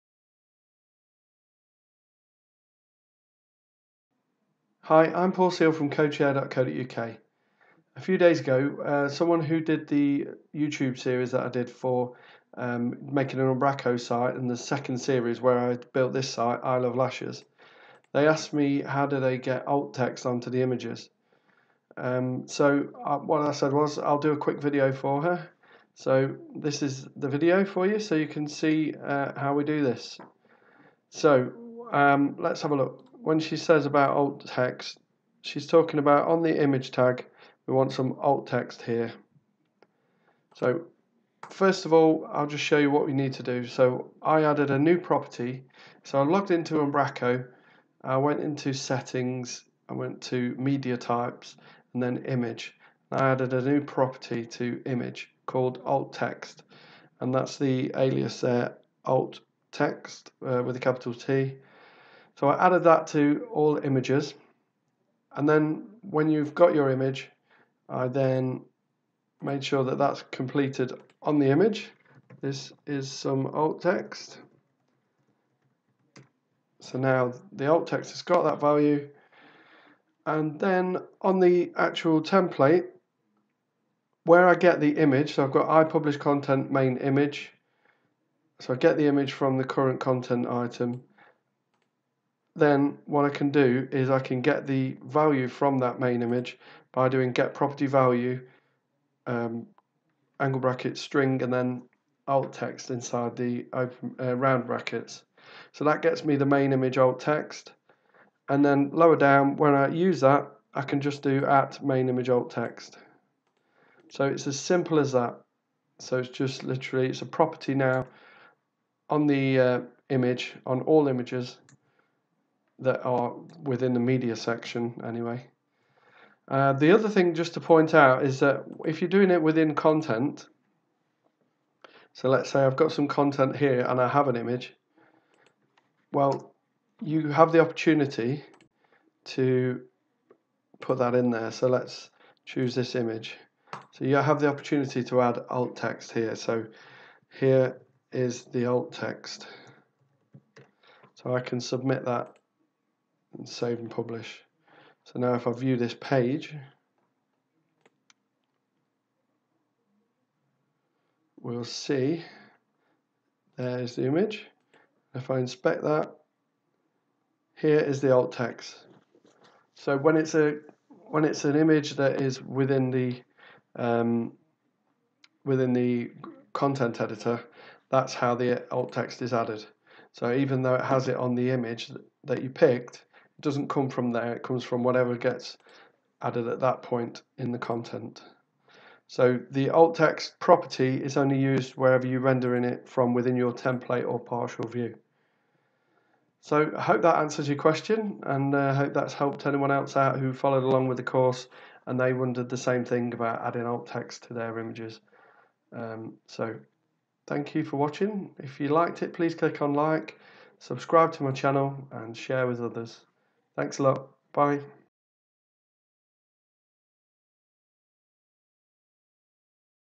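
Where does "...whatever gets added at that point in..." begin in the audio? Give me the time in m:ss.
3:04.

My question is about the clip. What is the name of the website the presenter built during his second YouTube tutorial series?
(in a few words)
Eye Love Lashes.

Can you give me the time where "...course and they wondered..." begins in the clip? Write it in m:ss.
3:21.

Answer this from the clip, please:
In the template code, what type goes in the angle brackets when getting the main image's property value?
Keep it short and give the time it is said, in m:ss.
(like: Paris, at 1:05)
string, at 1:40.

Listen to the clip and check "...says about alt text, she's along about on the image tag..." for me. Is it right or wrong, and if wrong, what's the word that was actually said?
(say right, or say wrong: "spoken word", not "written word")
wrong: "talking", not "along".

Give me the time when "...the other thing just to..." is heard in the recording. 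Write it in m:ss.
2:06.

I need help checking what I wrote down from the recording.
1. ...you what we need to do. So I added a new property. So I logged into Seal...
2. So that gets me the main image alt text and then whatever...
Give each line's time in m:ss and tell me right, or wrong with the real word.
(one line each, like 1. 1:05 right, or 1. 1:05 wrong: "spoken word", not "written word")
1. 0:42 wrong: "Umbraco", not "Seal"
2. 1:45 wrong: "lower", not "whatever".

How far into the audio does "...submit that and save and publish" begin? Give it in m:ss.
2:31.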